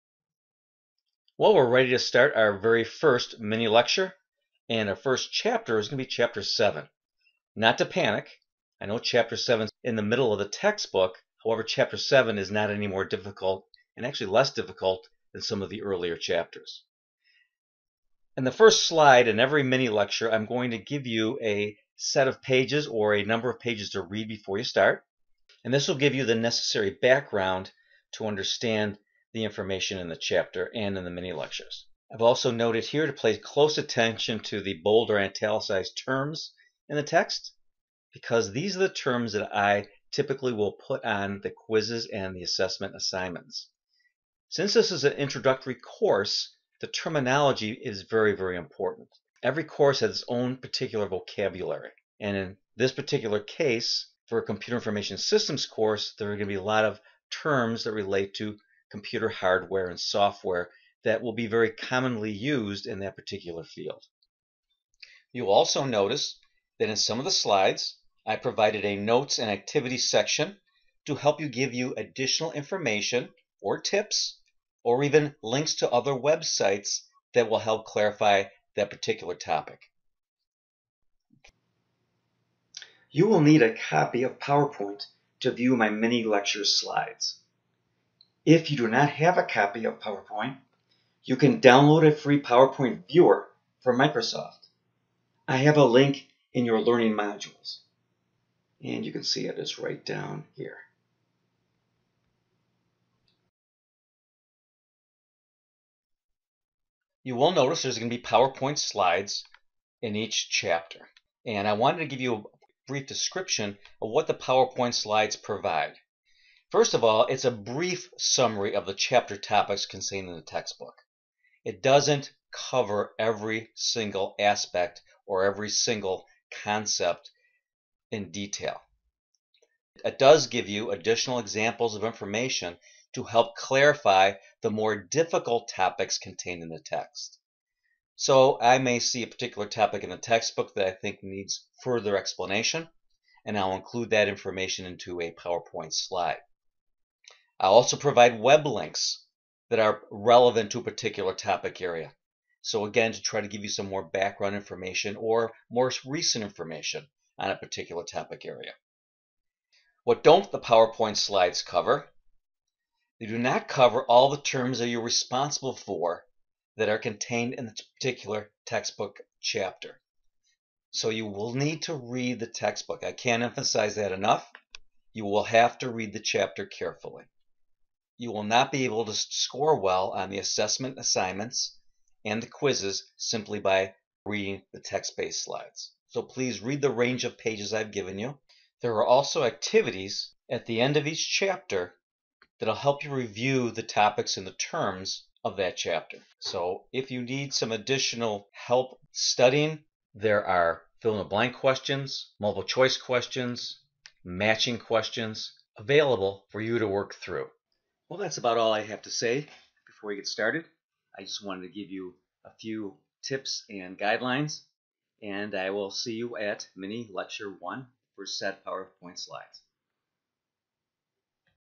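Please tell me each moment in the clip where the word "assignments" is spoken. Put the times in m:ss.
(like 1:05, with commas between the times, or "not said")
0:42, 3:00.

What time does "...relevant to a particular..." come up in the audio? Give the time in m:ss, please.
2:30.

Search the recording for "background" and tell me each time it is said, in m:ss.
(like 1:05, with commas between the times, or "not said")
0:26, 2:34.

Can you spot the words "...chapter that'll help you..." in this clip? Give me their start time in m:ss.
3:11.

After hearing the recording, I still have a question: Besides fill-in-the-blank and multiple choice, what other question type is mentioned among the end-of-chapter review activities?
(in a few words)
Matching questions.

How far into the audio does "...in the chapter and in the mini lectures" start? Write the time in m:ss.
0:29.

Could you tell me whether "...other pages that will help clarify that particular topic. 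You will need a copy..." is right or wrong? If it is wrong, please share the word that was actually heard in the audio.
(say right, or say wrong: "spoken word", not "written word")
wrong: "websites", not "pages".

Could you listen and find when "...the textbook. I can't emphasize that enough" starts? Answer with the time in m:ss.
2:52.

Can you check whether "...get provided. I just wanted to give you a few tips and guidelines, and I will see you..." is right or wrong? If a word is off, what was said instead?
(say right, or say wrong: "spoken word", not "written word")
wrong: "started", not "provided".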